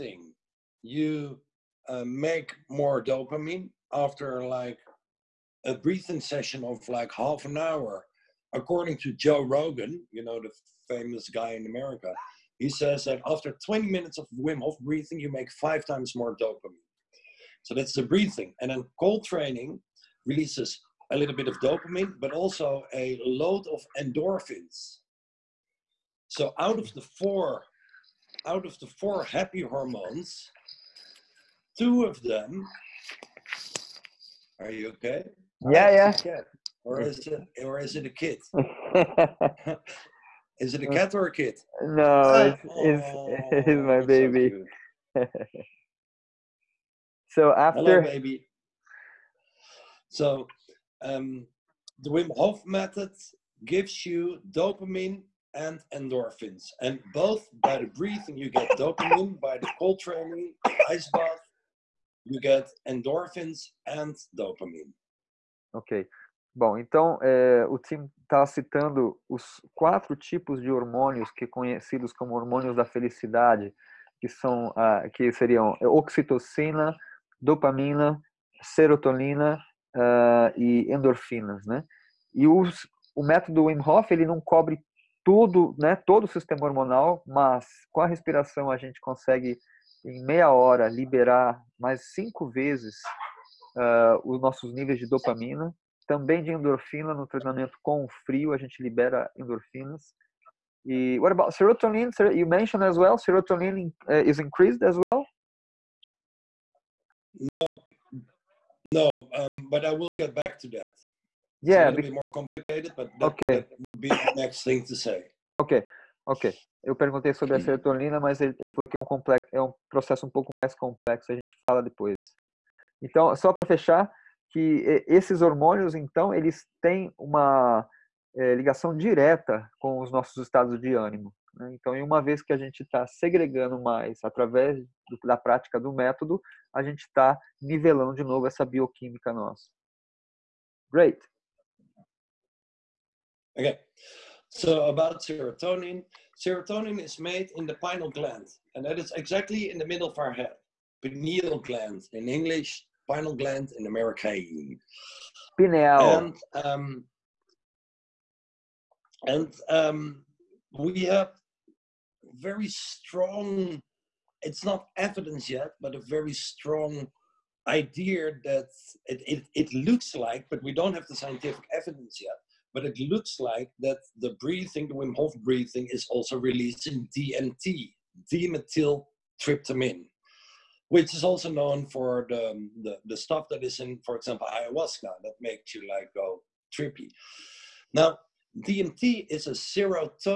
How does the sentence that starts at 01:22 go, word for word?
E os, o método Wim Hof ele não cobre tudo, né?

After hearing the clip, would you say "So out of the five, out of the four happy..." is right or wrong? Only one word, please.
wrong.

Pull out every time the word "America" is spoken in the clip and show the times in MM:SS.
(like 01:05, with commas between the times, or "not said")
00:11, 02:33.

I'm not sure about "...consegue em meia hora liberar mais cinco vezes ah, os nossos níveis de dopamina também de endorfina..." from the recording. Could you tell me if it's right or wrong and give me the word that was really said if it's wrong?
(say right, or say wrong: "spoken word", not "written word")
right.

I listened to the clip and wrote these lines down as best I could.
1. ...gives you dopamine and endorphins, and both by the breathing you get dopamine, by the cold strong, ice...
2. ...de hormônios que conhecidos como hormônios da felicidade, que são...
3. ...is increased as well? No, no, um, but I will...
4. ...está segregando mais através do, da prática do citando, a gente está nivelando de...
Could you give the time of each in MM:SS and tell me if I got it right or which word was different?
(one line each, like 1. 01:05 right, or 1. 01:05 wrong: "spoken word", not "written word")
1. 00:53 wrong: "training", not "strong"
2. 01:10 right
3. 01:44 right
4. 02:12 wrong: "método", not "citando".